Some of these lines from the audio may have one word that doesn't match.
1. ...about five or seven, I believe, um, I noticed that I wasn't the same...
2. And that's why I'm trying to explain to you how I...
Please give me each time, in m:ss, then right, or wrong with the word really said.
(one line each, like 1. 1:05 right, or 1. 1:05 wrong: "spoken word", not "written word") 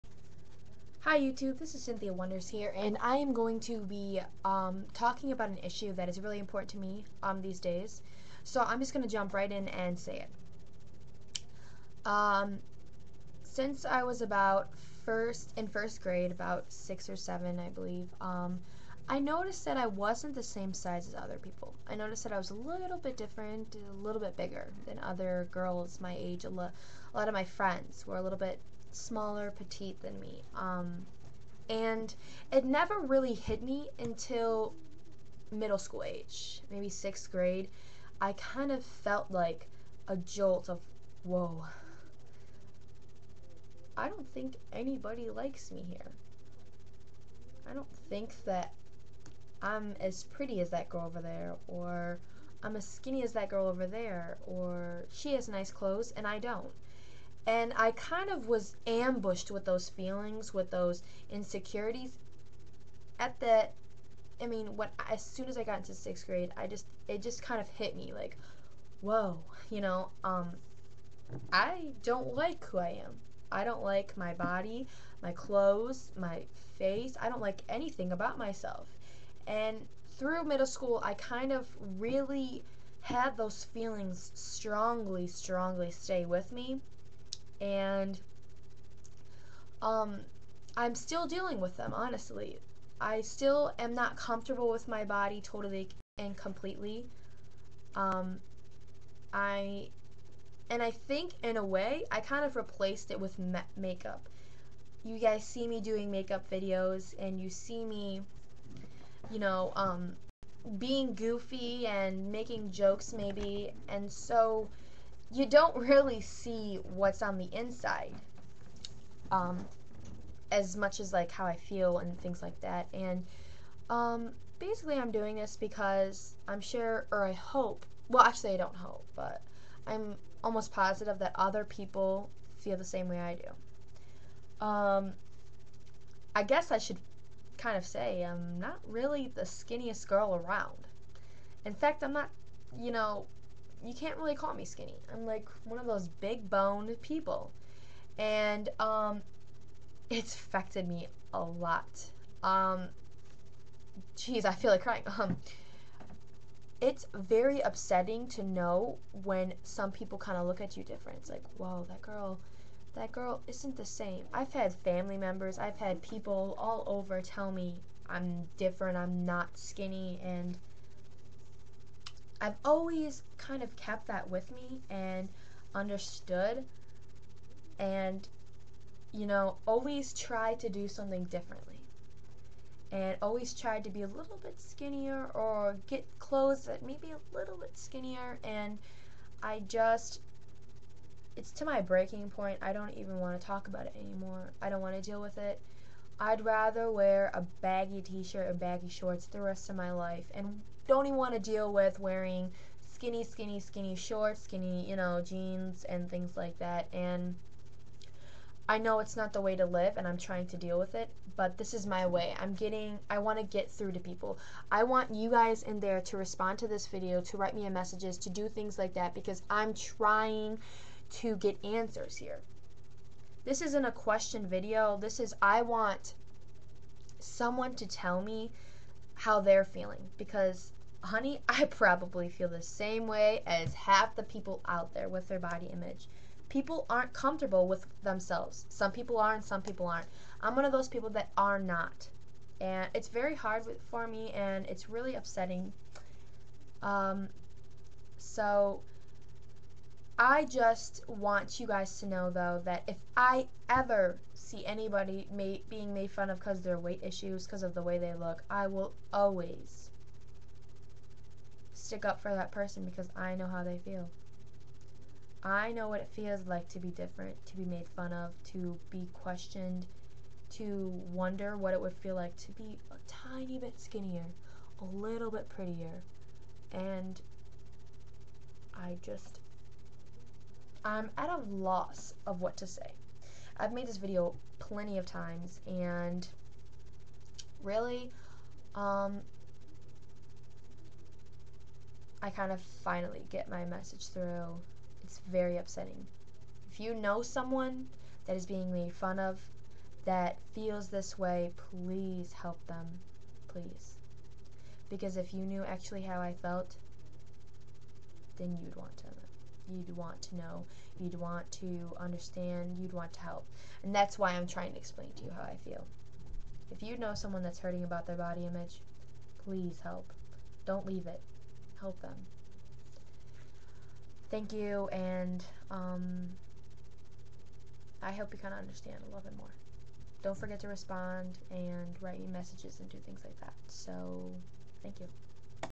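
1. 0:16 wrong: "six", not "five"
2. 5:13 right.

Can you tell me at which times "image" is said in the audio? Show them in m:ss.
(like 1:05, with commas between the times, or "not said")
3:55, 5:18.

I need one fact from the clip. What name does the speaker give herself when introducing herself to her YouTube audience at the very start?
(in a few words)
Cynthia Wonders.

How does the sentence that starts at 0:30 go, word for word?
Um, and it never really hit me until middle school age, maybe sixth grade.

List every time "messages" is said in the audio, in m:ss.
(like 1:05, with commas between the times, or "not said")
3:37, 4:53, 5:32.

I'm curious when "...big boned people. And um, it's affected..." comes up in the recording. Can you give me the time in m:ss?
2:26.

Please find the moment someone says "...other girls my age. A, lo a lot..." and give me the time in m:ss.
0:24.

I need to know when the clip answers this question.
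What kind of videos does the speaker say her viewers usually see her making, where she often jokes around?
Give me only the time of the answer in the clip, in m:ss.
1:46.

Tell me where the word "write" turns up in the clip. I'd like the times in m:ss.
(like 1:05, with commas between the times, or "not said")
3:37, 5:31.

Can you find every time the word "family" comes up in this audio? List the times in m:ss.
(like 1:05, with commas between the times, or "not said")
2:44.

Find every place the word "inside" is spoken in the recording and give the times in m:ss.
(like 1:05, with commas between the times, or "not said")
1:57.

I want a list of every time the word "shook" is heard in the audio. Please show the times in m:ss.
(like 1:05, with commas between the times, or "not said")
not said.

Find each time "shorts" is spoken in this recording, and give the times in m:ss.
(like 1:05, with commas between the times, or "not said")
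3:18, 3:23.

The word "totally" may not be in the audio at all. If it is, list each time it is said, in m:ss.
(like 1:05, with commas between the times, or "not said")
1:35.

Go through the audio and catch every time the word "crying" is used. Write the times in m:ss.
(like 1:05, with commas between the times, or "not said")
2:34.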